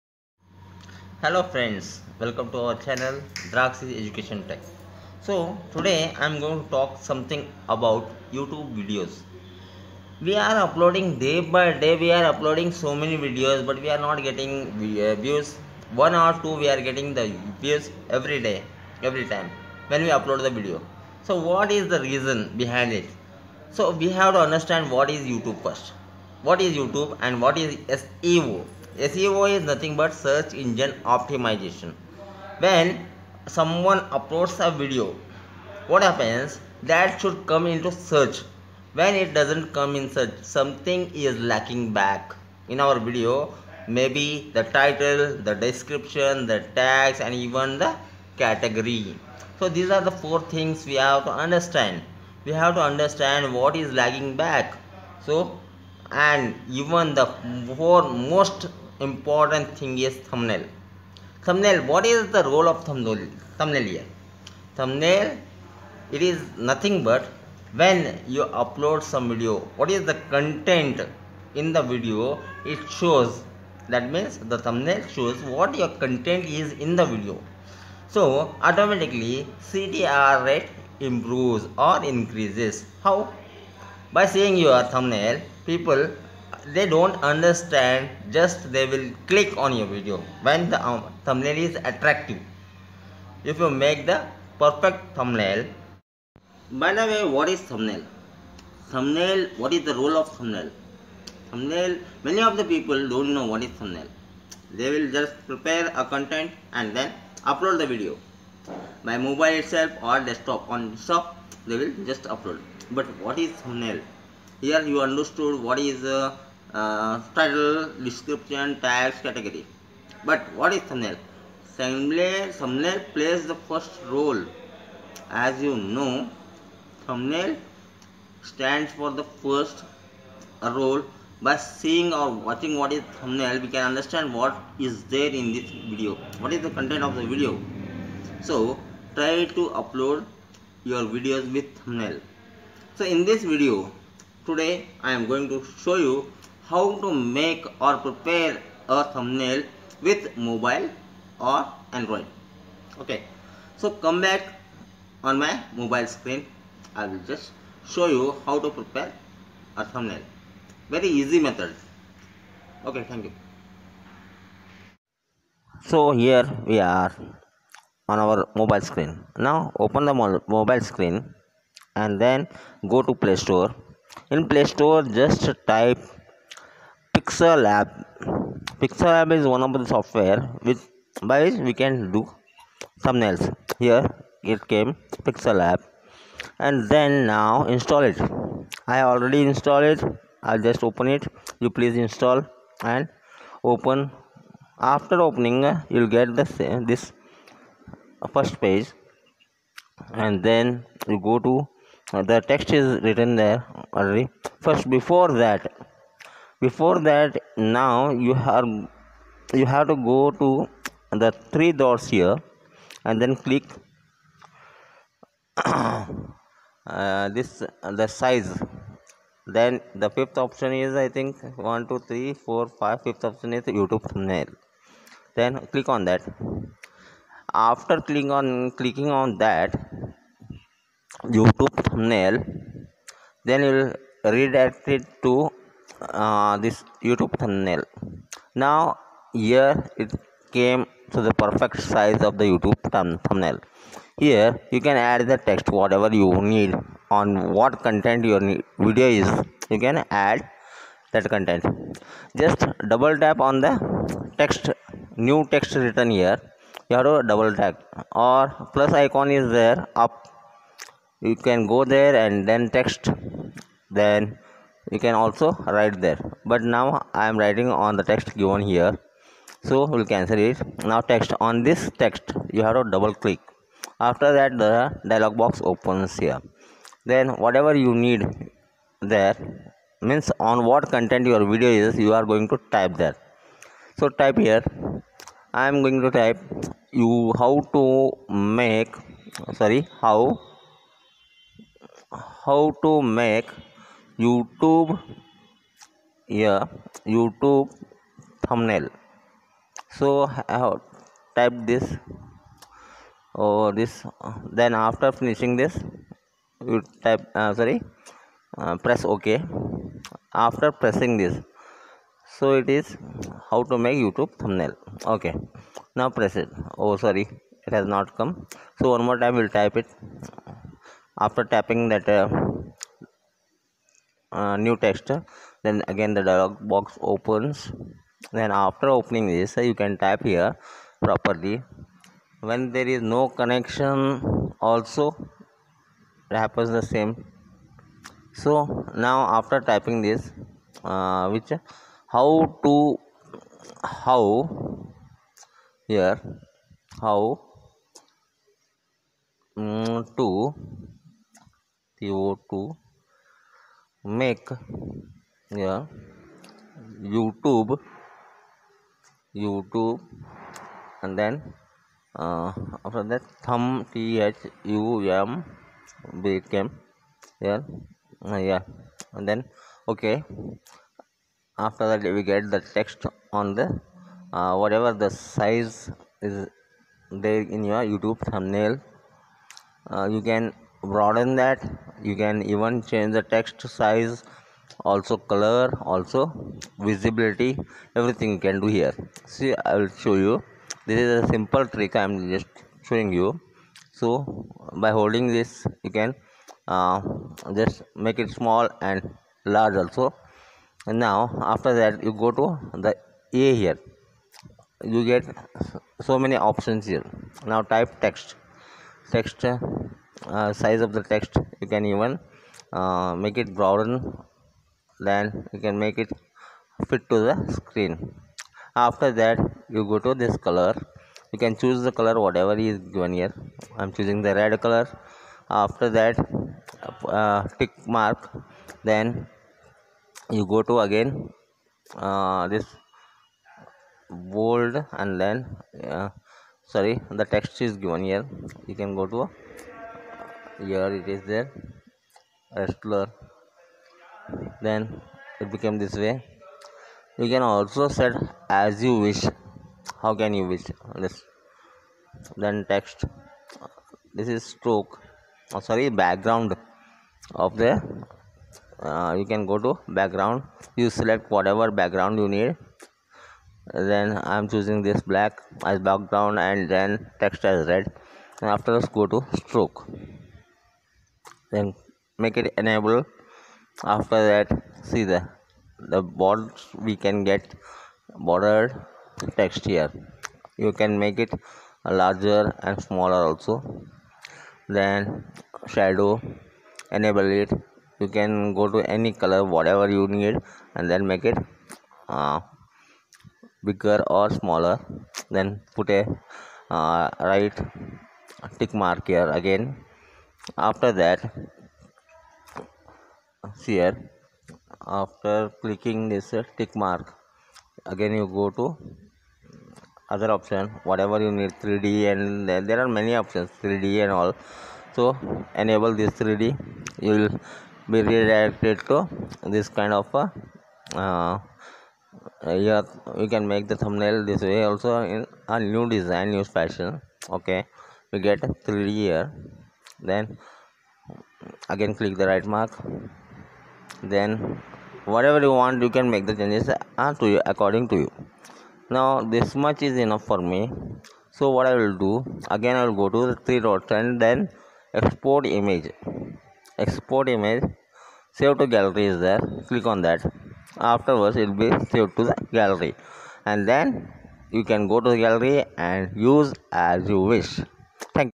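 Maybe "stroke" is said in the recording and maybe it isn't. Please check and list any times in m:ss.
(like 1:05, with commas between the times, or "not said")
7:34, 7:49.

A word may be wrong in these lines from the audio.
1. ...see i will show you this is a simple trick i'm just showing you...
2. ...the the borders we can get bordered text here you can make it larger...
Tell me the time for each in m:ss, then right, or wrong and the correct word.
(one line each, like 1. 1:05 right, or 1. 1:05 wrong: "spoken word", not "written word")
1. 6:29 right
2. 7:55 right.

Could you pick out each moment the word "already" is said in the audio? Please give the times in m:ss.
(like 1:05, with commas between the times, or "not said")
3:09, 3:23.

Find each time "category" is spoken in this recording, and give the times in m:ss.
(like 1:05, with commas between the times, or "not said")
0:48, 1:59.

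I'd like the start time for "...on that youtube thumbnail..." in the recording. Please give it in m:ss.
3:49.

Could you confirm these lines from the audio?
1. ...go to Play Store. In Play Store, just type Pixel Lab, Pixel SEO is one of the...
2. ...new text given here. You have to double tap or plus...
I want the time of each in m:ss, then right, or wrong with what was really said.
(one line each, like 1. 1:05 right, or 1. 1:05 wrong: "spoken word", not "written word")
1. 2:52 wrong: "Lab", not "SEO"
2. 4:15 wrong: "written", not "given".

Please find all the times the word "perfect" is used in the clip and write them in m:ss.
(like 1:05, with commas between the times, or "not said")
1:34, 4:01.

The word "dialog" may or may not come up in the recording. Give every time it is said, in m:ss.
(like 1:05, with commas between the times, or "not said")
4:35, 5:26.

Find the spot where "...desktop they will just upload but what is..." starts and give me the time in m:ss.
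1:50.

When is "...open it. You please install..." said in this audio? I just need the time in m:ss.
3:10.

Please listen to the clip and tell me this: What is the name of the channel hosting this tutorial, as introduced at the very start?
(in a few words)
Draxis Education Tech.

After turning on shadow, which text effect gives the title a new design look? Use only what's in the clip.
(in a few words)
3D.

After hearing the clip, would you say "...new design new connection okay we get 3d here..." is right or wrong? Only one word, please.
wrong.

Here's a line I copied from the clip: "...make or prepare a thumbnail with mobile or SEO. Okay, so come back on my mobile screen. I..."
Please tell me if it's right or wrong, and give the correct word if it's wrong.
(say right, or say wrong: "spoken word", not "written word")
wrong: "Android", not "SEO".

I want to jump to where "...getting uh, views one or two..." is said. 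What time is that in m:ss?
0:14.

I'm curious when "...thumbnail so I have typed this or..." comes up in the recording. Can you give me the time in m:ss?
4:58.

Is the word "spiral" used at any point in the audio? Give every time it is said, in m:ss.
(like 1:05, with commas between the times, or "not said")
not said.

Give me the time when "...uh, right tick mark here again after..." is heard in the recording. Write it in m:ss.
8:16.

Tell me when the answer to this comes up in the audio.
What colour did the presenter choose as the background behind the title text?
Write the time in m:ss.
7:45.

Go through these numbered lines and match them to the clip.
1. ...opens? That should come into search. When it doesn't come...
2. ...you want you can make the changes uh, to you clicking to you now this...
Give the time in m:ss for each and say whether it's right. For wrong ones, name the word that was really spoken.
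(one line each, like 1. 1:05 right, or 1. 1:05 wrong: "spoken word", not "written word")
1. 0:36 wrong: "happens", not "opens"
2. 8:55 wrong: "according", not "clicking".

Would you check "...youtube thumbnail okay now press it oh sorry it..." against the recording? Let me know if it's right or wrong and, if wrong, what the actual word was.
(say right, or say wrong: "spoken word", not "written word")
right.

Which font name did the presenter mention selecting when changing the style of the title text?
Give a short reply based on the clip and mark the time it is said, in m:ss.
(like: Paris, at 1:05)
Restler, at 7:22.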